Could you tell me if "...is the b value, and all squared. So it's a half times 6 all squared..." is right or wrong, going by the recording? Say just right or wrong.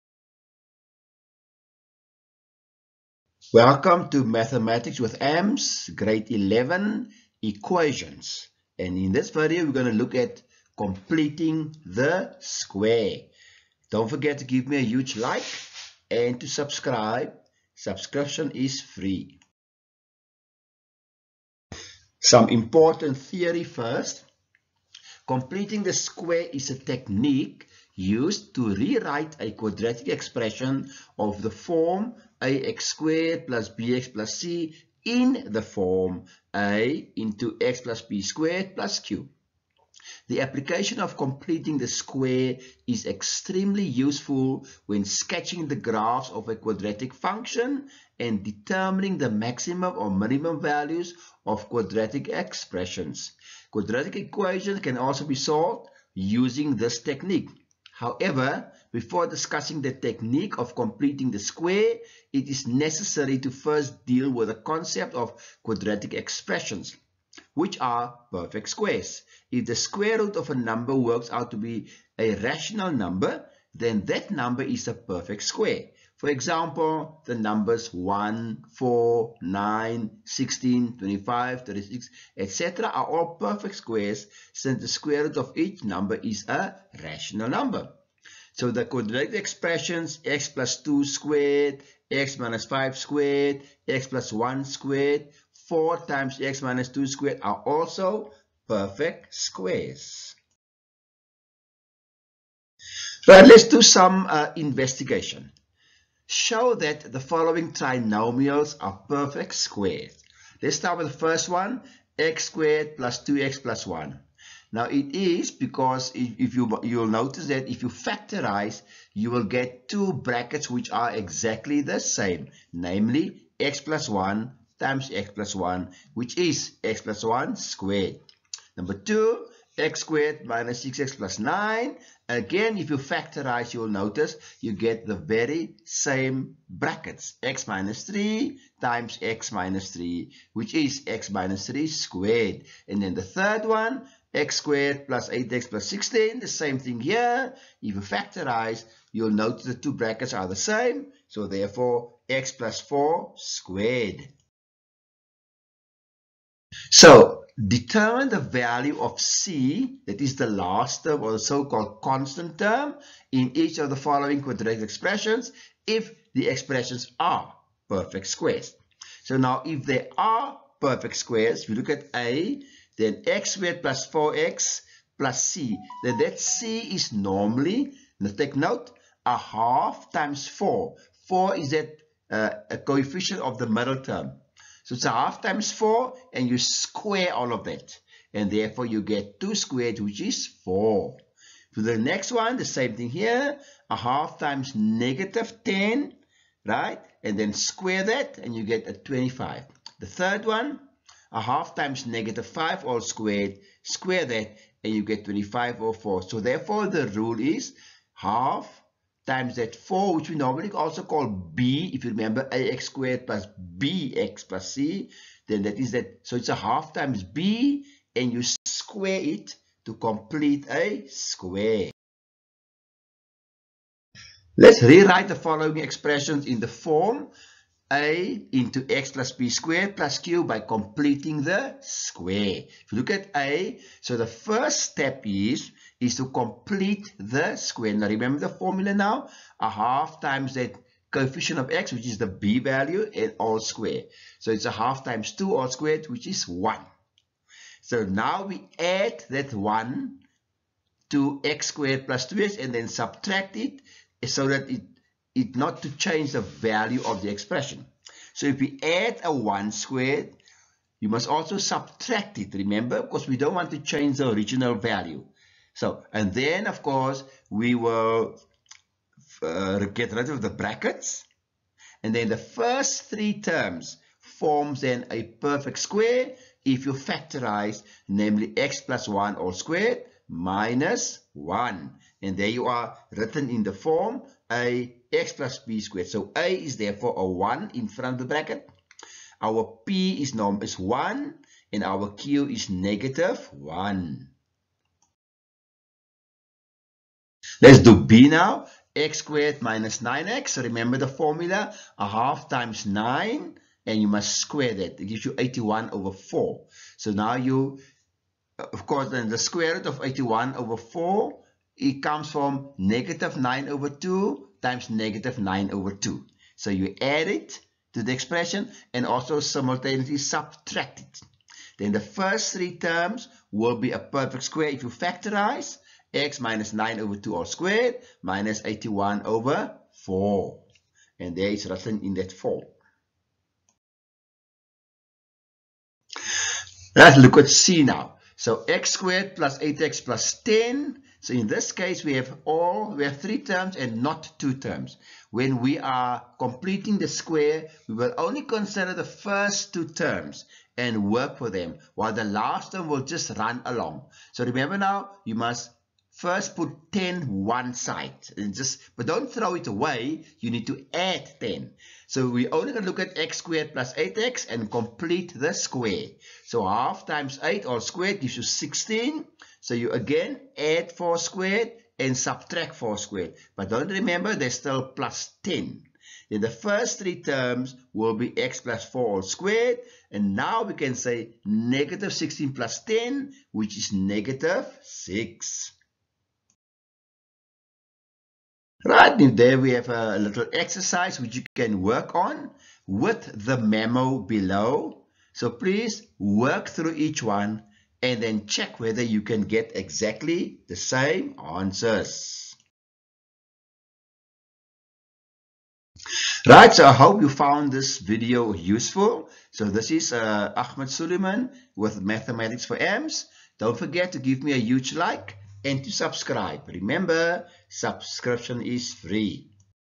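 wrong.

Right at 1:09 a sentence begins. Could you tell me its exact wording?
If the square root of a number works out to be a rational number, then that number is a perfect square.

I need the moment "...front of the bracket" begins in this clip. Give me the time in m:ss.
4:47.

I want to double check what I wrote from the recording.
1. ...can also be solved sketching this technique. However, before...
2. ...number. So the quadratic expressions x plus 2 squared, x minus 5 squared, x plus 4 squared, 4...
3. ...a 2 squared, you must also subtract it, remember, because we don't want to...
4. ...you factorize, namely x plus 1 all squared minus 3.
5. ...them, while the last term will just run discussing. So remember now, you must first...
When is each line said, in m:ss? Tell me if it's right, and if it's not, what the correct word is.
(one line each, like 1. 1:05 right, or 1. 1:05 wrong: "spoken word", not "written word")
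1. 0:54 wrong: "using", not "sketching"
2. 1:27 wrong: "1", not "4"
3. 4:19 wrong: "1", not "2"
4. 4:36 wrong: "1", not "3"
5. 5:51 wrong: "along", not "discussing".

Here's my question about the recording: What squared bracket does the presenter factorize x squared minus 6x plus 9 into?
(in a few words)
(x - 3)².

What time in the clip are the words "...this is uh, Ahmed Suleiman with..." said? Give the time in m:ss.
6:49.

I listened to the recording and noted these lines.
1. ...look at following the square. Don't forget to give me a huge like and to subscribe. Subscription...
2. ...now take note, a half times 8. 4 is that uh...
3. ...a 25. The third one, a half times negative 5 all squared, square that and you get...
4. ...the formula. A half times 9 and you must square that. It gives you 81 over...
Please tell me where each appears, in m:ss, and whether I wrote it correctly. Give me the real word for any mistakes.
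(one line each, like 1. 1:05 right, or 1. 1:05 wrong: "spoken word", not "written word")
1. 0:09 wrong: "completing", not "following"
2. 2:58 wrong: "4", not "8"
3. 3:18 right
4. 5:00 right.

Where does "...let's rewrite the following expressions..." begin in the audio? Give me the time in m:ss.
3:44.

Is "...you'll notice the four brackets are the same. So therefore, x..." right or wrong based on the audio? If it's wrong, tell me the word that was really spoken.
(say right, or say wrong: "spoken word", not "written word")
wrong: "two", not "four".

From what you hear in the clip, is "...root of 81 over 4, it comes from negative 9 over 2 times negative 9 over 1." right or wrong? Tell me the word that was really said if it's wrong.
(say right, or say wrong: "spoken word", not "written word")
wrong: "2", not "1".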